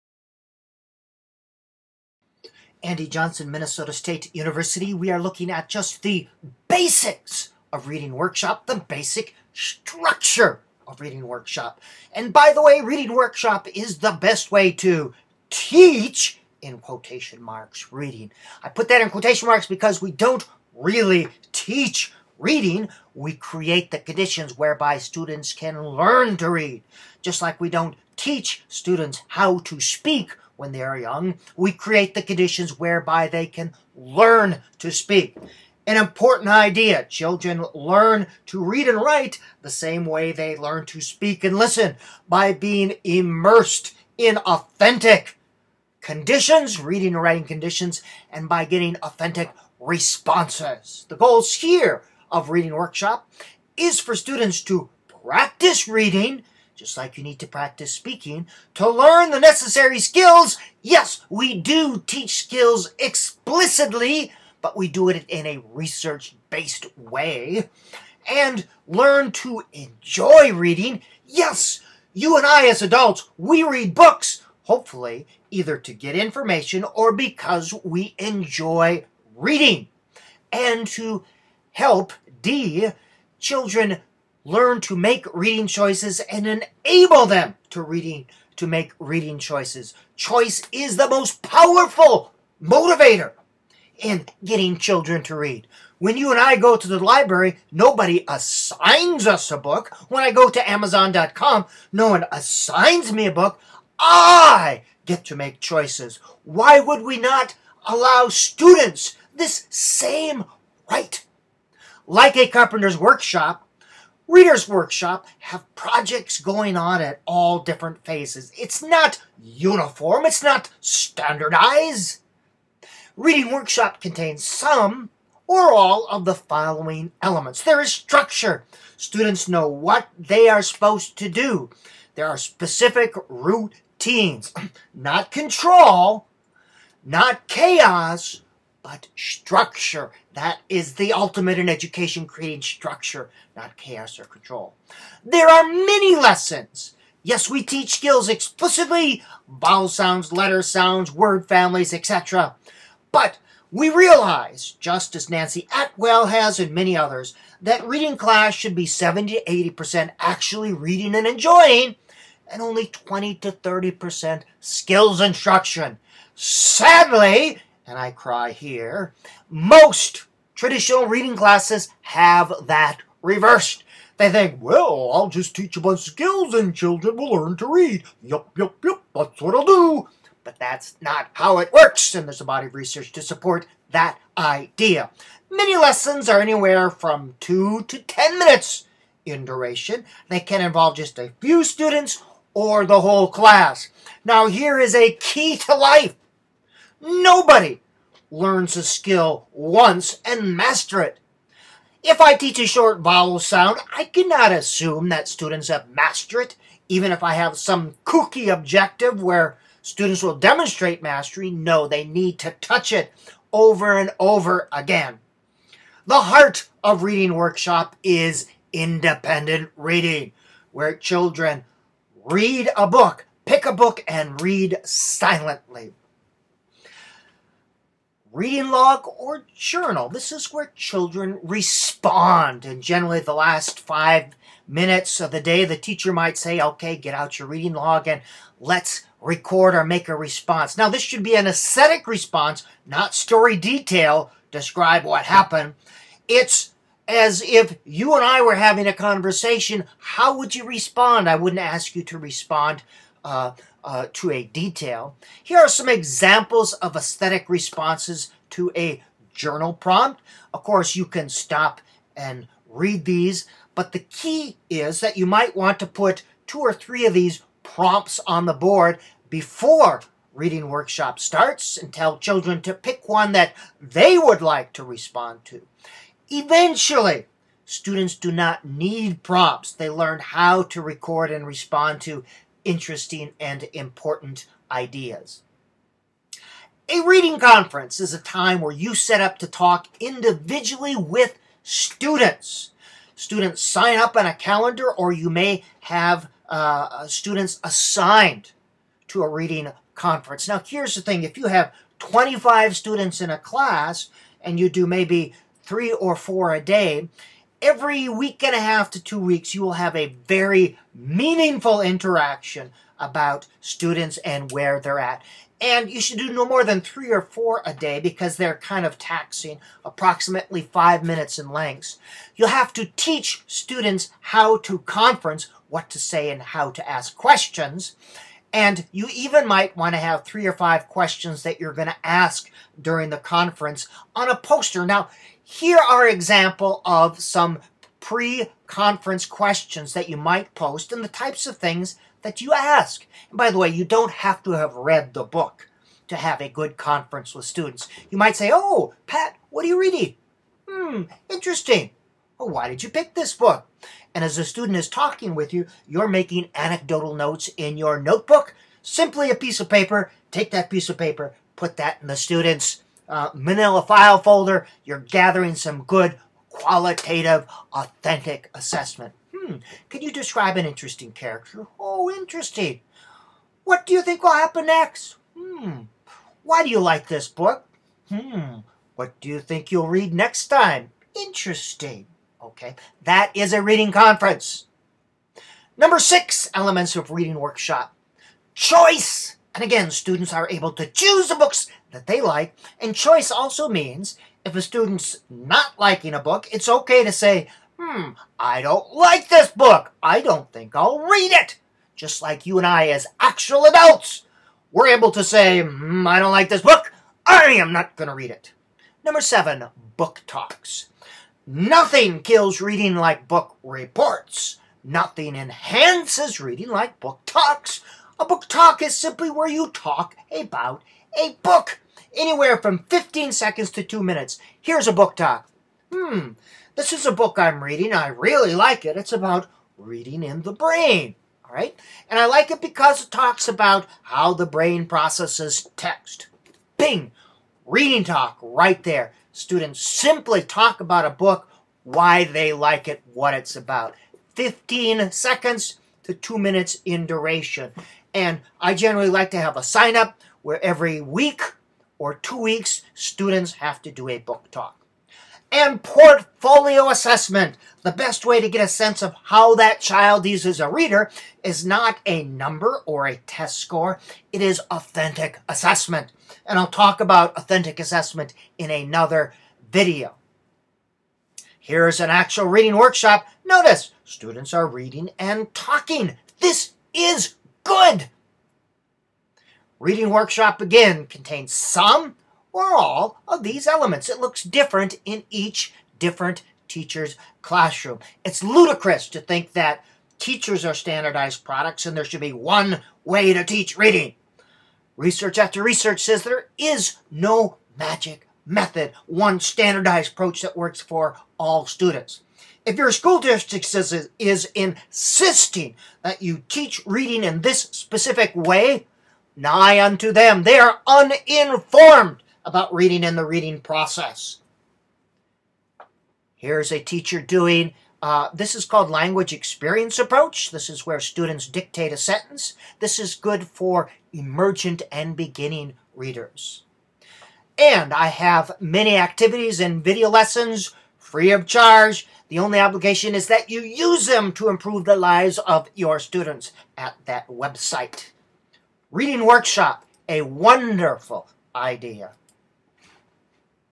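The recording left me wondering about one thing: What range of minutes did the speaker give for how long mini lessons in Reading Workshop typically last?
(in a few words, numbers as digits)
2 to 10 minutes.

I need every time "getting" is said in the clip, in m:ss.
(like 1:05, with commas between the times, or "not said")
0:48, 1:34.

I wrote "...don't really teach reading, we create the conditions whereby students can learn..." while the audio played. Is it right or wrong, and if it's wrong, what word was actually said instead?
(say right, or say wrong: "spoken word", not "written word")
right.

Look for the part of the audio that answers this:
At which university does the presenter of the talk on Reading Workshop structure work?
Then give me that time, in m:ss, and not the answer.
0:03.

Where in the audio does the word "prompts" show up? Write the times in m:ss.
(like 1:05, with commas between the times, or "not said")
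4:19, 4:27, 4:39.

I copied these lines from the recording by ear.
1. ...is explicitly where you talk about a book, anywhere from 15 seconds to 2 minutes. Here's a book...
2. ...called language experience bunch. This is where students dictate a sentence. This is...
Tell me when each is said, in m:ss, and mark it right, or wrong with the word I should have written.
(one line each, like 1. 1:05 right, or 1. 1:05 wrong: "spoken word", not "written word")
1. 6:58 wrong: "simply", not "explicitly"
2. 8:38 wrong: "approach", not "bunch".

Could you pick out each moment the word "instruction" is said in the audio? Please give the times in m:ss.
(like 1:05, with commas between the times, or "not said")
2:45.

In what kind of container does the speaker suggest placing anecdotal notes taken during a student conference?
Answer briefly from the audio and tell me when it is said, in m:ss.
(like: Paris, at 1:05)
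Manila file folder, at 6:03.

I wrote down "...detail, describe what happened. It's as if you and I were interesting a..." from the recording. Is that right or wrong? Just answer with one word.
wrong.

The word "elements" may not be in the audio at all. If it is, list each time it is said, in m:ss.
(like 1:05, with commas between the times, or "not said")
2:07, 6:26, 8:03.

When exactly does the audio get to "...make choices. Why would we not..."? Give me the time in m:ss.
1:45.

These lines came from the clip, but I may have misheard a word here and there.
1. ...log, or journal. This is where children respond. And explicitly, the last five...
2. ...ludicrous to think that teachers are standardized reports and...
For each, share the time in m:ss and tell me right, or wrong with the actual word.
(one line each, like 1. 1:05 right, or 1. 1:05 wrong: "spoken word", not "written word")
1. 3:48 wrong: "generally", not "explicitly"
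2. 8:08 wrong: "products", not "reports".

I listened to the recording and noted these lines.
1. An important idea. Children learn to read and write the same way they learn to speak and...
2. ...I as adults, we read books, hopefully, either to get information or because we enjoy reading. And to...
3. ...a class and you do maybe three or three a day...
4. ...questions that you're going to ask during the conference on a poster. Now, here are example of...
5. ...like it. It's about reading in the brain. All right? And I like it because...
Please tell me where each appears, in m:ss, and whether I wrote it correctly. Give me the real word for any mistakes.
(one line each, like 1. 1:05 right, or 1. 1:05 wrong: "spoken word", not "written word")
1. 0:35 right
2. 1:12 right
3. 5:03 wrong: "four", not "three"
4. 5:30 right
5. 7:08 right.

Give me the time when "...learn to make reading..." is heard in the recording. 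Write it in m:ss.
1:24.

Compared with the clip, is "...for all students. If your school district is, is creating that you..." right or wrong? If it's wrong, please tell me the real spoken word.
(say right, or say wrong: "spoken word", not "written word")
wrong: "insisting", not "creating".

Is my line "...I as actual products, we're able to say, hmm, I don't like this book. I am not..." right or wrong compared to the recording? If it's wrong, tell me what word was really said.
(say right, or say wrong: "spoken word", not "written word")
wrong: "adults", not "products".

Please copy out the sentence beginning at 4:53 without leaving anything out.
Students sign up on a calendar, or you may have uh, students assigned to a reading conference.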